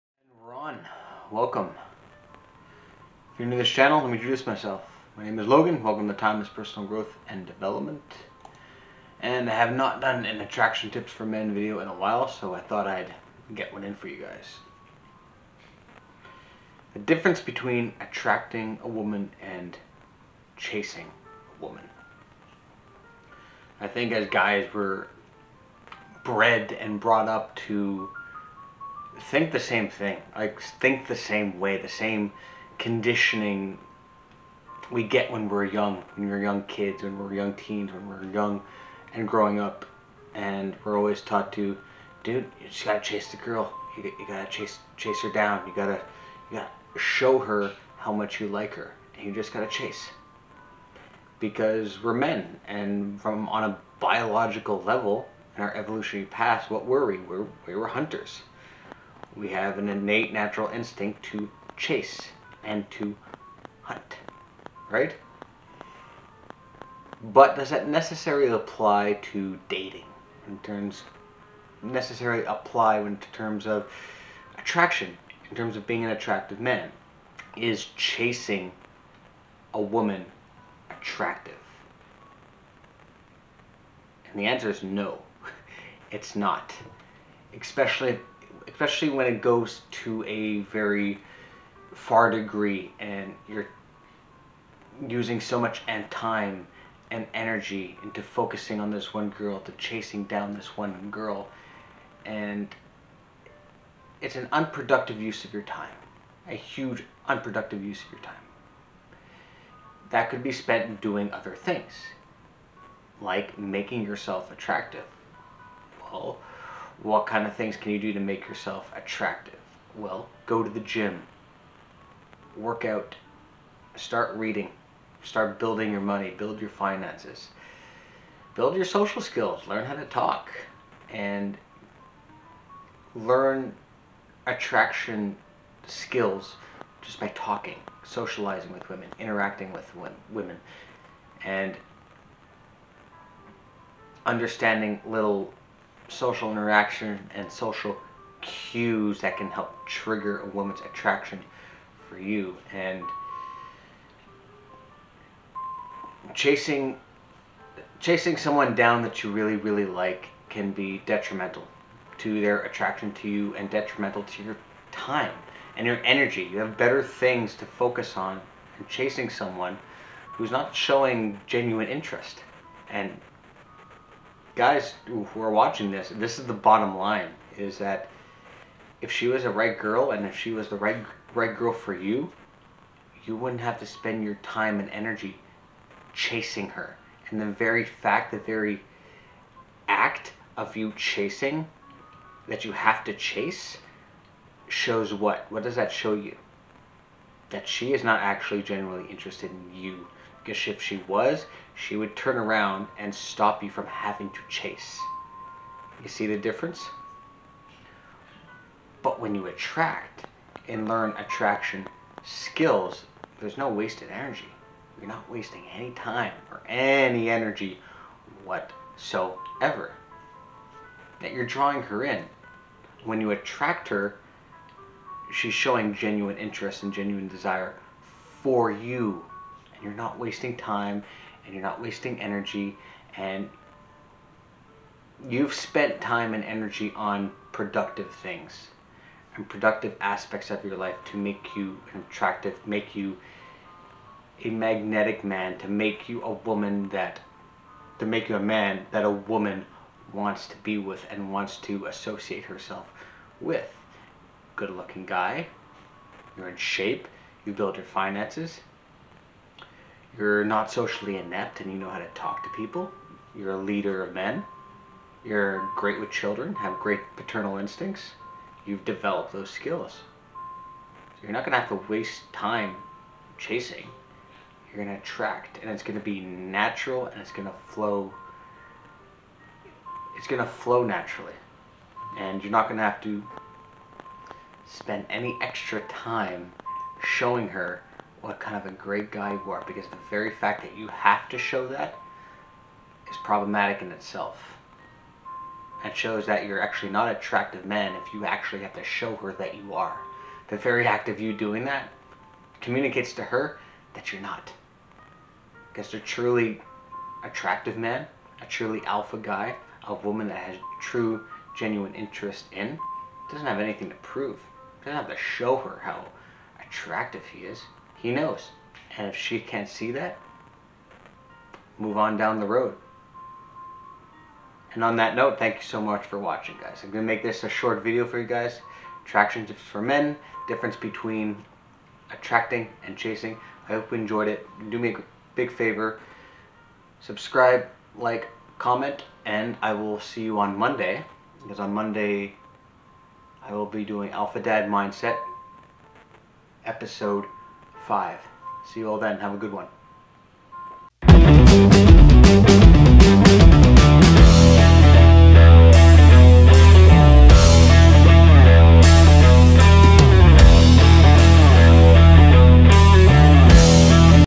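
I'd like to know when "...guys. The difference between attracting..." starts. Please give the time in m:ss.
0:14.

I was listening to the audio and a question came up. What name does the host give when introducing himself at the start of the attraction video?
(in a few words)
Logan.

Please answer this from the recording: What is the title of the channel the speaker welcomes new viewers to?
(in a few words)
Timeless Personal Growth and Development.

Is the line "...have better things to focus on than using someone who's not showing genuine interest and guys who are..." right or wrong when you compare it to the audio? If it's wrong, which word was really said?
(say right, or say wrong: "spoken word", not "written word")
wrong: "chasing", not "using".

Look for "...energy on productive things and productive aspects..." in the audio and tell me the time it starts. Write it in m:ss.
3:56.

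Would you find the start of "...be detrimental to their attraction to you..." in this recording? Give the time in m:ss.
2:40.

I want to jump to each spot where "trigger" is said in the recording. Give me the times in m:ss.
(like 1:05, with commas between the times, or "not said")
2:29.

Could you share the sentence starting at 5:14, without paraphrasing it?
Doesn't have to show her how attractive he is he knows.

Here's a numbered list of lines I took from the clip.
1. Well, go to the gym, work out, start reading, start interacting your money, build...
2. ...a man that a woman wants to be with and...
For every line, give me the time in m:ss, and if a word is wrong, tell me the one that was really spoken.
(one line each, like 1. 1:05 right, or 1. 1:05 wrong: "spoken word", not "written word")
1. 1:59 wrong: "building", not "interacting"
2. 4:08 right.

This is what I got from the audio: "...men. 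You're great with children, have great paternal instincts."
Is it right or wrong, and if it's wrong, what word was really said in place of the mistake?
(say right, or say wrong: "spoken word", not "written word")
right.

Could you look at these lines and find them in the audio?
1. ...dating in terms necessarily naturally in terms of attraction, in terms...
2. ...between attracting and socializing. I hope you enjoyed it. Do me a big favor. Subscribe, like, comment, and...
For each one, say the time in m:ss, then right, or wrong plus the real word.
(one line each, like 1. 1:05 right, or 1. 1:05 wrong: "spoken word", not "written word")
1. 1:09 wrong: "apply", not "naturally"
2. 5:30 wrong: "chasing", not "socializing".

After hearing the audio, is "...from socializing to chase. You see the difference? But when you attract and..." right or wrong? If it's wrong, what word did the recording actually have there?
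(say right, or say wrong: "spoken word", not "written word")
wrong: "having", not "socializing".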